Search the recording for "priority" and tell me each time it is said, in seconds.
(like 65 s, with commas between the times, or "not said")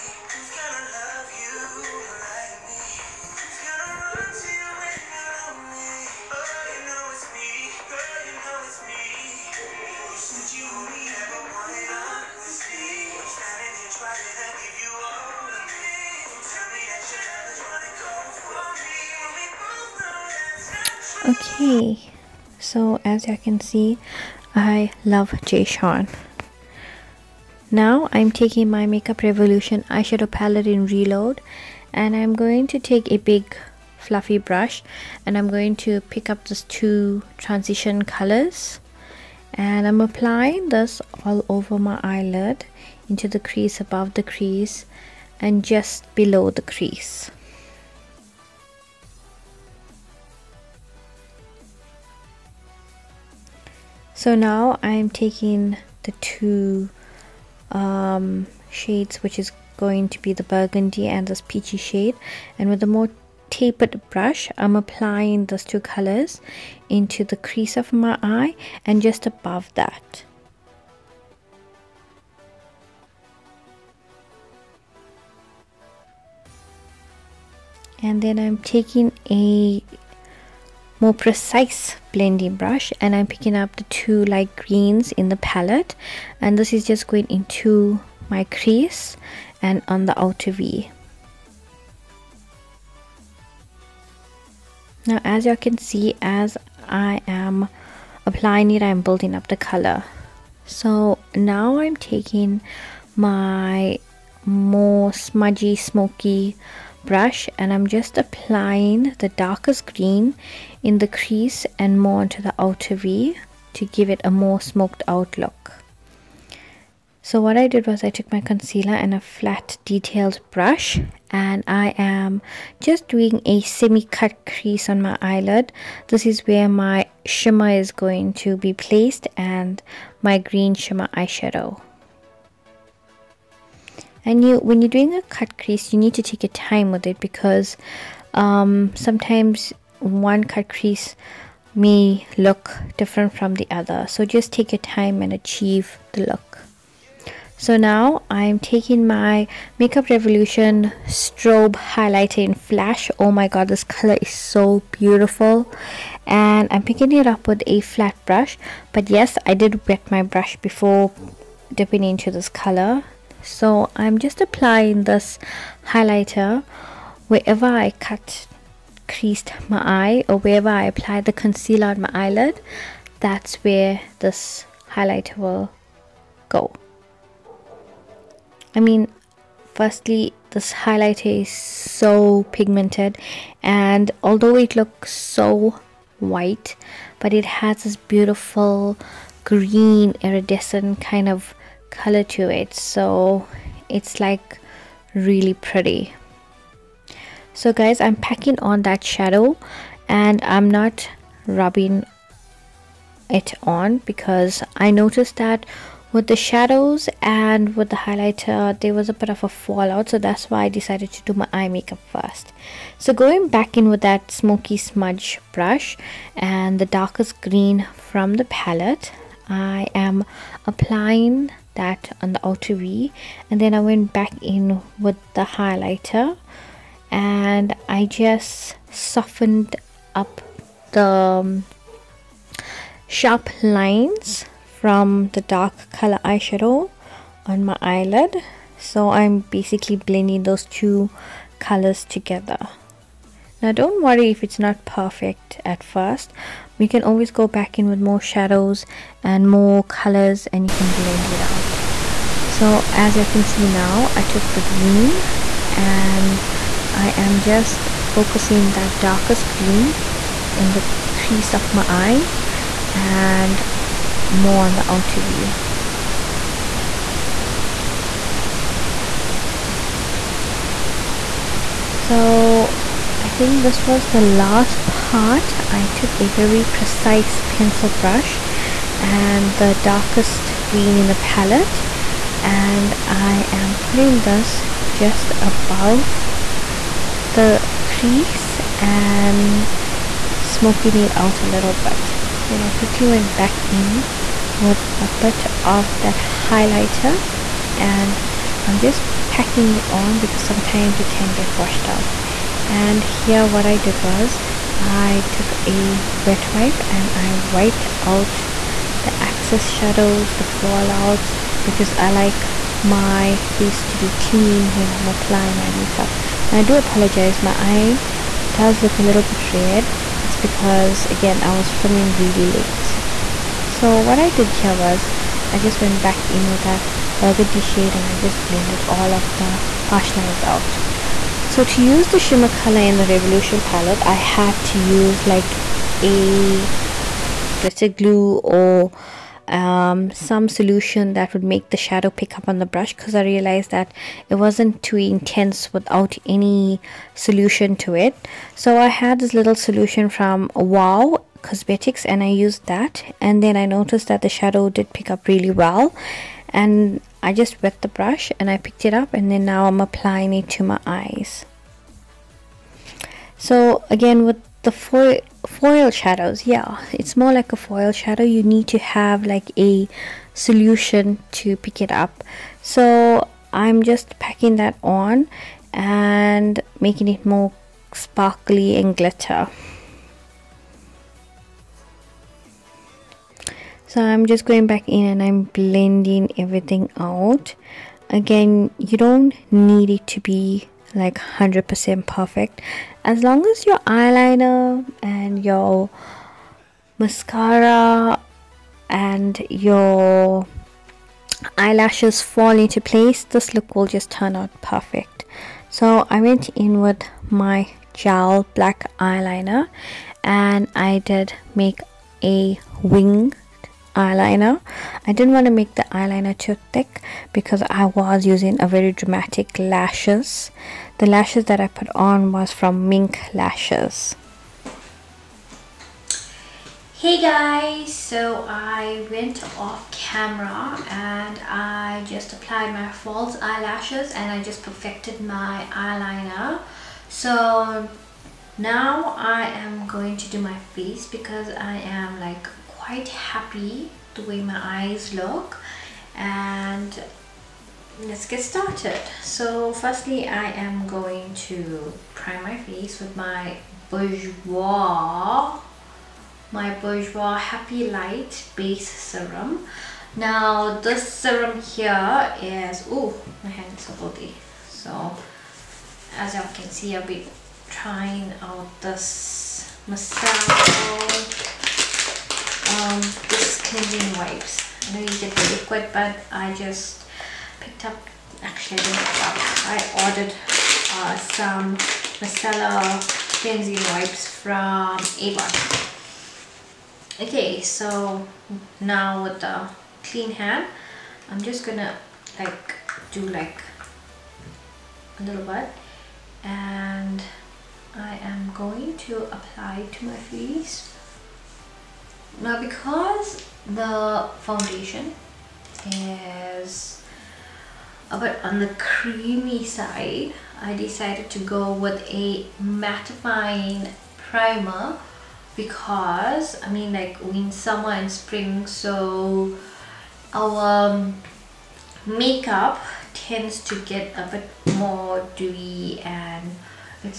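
not said.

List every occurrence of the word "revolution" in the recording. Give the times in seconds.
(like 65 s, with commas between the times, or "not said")
29 s, 150 s, 333 s.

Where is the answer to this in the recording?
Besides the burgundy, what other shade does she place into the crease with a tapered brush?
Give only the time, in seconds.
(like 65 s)
61 s.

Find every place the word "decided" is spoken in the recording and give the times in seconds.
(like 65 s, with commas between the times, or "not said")
210 s, 510 s.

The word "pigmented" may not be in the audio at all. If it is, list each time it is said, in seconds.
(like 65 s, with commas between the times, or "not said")
182 s.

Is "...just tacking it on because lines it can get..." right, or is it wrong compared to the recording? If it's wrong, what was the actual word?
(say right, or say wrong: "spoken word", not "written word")
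wrong: "sometimes", not "lines".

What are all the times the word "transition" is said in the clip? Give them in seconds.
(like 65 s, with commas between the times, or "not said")
37 s.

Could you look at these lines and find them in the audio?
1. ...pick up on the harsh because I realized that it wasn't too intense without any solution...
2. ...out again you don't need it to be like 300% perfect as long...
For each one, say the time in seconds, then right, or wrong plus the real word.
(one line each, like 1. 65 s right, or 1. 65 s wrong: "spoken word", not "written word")
1. 342 s wrong: "brush", not "harsh"
2. 386 s wrong: "100", not "300".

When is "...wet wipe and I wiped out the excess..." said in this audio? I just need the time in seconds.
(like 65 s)
306 s.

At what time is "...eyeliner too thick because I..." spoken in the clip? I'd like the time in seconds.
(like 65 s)
415 s.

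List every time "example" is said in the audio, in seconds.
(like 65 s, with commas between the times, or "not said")
not said.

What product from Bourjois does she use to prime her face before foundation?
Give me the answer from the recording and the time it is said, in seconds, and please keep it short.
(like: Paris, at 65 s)
happy light base serum, at 457 s.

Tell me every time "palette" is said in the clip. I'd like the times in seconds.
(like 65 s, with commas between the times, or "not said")
30 s, 85 s, 218 s, 281 s, 333 s.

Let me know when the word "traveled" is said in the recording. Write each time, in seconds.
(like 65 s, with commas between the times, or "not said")
not said.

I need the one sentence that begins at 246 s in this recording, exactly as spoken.
We can always go back in with more shadows and more colors and you can blend it out.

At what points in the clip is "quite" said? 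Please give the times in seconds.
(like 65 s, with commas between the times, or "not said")
442 s.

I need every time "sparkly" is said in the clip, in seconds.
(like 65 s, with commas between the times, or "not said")
377 s.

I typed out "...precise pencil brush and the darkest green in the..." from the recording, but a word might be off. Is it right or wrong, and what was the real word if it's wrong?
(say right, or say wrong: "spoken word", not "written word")
right.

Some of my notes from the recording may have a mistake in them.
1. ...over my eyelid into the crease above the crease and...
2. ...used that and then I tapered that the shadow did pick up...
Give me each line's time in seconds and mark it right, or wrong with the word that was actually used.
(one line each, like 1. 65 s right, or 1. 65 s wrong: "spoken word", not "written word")
1. 41 s right
2. 352 s wrong: "noticed", not "tapered".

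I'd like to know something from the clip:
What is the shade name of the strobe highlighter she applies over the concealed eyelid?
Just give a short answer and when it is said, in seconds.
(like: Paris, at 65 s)
Flash, at 152 s.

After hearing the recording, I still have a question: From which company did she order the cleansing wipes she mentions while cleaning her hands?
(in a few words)
Avon.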